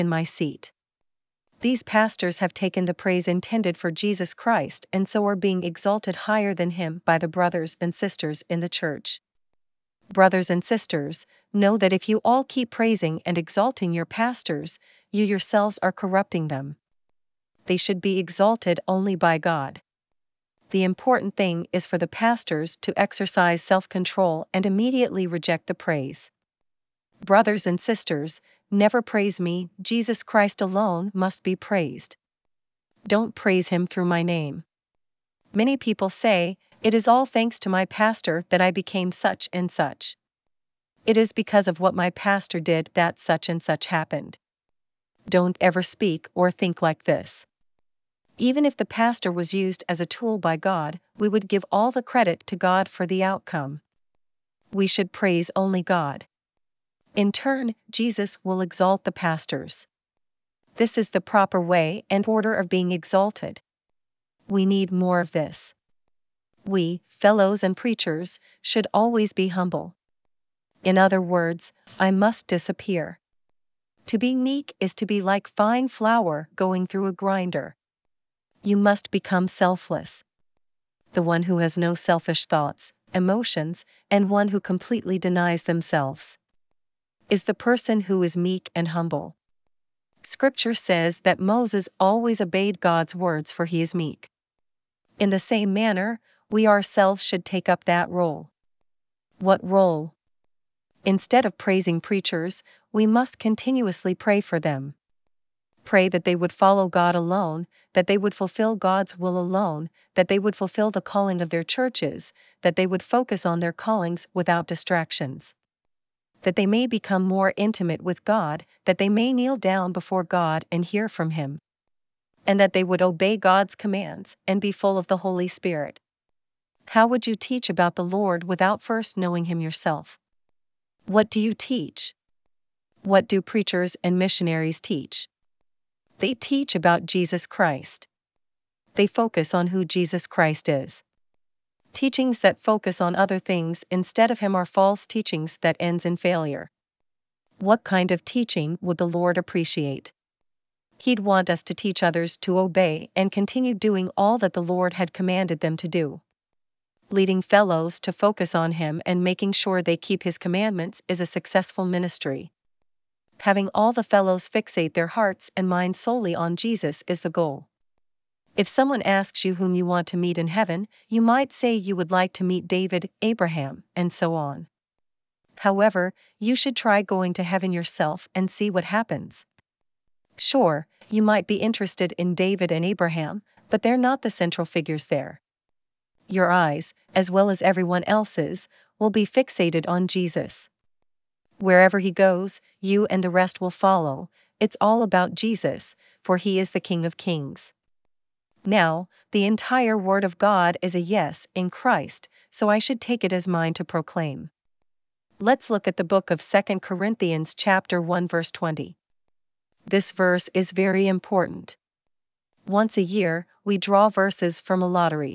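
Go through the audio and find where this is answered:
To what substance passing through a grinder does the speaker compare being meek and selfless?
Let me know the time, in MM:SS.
01:15.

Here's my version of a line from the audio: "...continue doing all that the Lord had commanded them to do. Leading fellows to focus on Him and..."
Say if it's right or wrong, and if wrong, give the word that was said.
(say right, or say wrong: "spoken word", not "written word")
right.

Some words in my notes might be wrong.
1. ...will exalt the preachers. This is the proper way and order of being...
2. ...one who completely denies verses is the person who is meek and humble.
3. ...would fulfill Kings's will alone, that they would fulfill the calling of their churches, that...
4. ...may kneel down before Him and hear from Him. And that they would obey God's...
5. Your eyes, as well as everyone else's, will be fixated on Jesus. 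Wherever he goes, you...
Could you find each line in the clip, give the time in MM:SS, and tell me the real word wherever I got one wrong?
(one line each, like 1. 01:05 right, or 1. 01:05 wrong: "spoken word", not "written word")
1. 00:58 wrong: "pastors", not "preachers"
2. 01:24 wrong: "themselves", not "verses"
3. 01:48 wrong: "God", not "Kings"
4. 01:59 wrong: "God", not "Him"
5. 03:06 right.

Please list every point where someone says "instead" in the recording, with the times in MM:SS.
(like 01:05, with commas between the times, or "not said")
01:41, 02:23.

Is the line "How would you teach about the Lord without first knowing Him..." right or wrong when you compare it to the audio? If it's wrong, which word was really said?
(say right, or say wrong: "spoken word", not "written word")
right.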